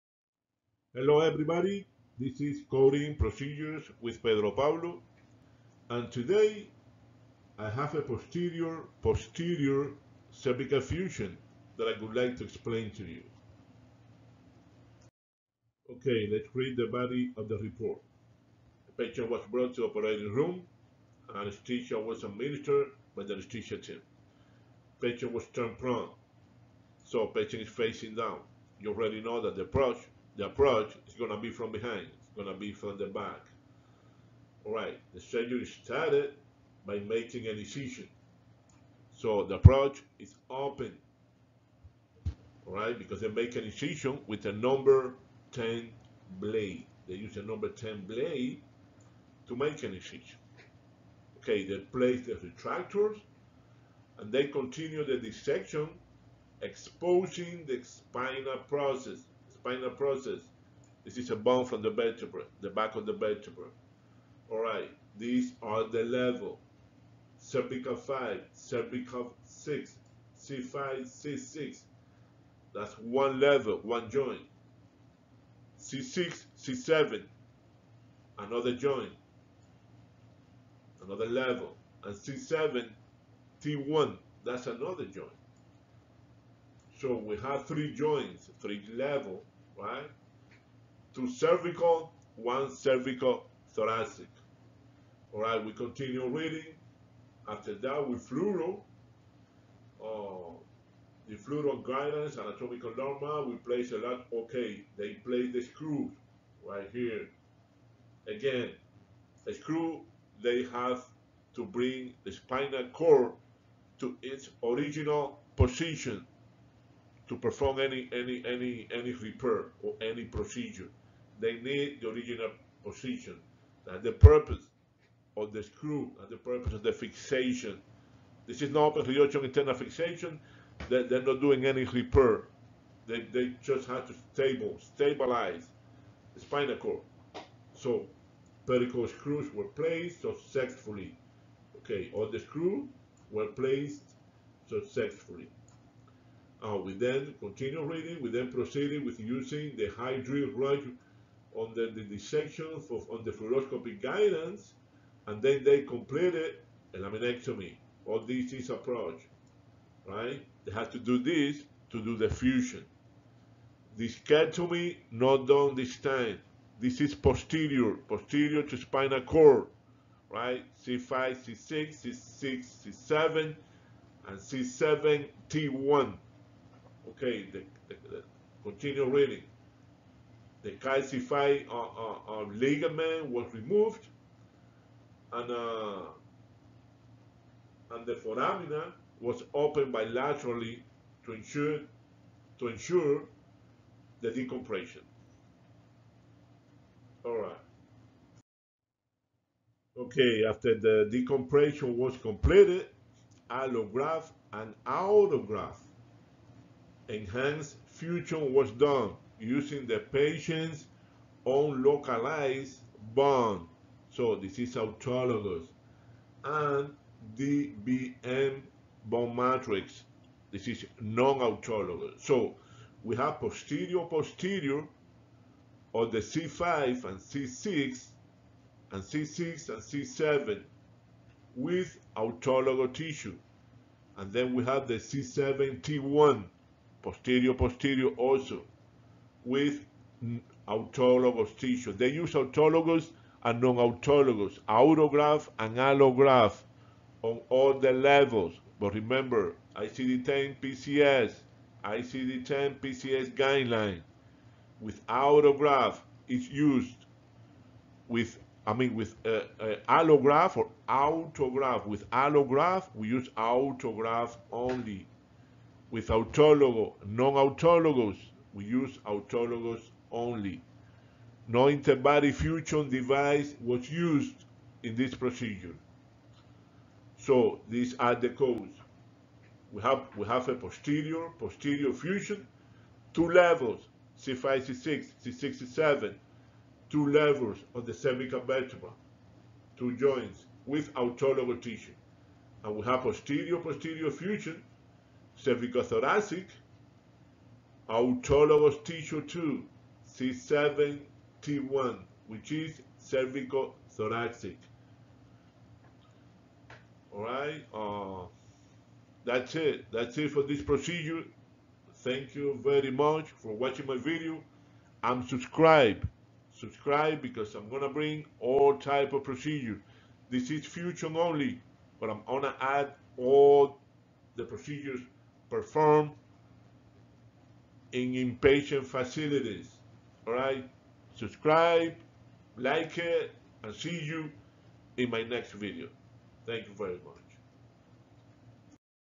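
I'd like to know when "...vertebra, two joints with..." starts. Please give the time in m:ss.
4:48.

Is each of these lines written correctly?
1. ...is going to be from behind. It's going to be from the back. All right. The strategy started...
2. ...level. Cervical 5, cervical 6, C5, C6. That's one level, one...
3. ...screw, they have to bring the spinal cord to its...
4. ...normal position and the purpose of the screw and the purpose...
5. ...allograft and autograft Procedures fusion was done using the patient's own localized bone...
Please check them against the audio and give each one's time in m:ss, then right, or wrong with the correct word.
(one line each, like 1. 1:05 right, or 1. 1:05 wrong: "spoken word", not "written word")
1. 0:31 right
2. 1:06 right
3. 1:49 right
4. 2:02 wrong: "original", not "normal"
5. 3:23 wrong: "Enhanced", not "Procedures".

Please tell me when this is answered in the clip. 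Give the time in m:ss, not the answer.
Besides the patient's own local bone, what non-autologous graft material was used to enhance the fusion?
3:37.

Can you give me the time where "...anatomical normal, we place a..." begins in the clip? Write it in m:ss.
1:42.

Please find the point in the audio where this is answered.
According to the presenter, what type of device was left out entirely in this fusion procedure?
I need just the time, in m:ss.
4:31.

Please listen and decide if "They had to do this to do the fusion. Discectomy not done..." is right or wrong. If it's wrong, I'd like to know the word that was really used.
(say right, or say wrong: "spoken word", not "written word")
right.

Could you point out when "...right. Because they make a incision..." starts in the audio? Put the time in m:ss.
0:42.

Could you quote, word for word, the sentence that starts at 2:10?
They, they're not doing any repair.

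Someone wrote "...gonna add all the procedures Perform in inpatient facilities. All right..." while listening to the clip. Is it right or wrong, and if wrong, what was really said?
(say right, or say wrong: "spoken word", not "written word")
right.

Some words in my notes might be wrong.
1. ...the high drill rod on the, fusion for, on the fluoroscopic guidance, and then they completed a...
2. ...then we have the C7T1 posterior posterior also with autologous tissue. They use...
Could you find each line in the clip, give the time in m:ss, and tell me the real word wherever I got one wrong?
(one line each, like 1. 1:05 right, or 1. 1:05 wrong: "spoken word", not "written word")
1. 2:29 wrong: "dissection", not "fusion"
2. 3:54 right.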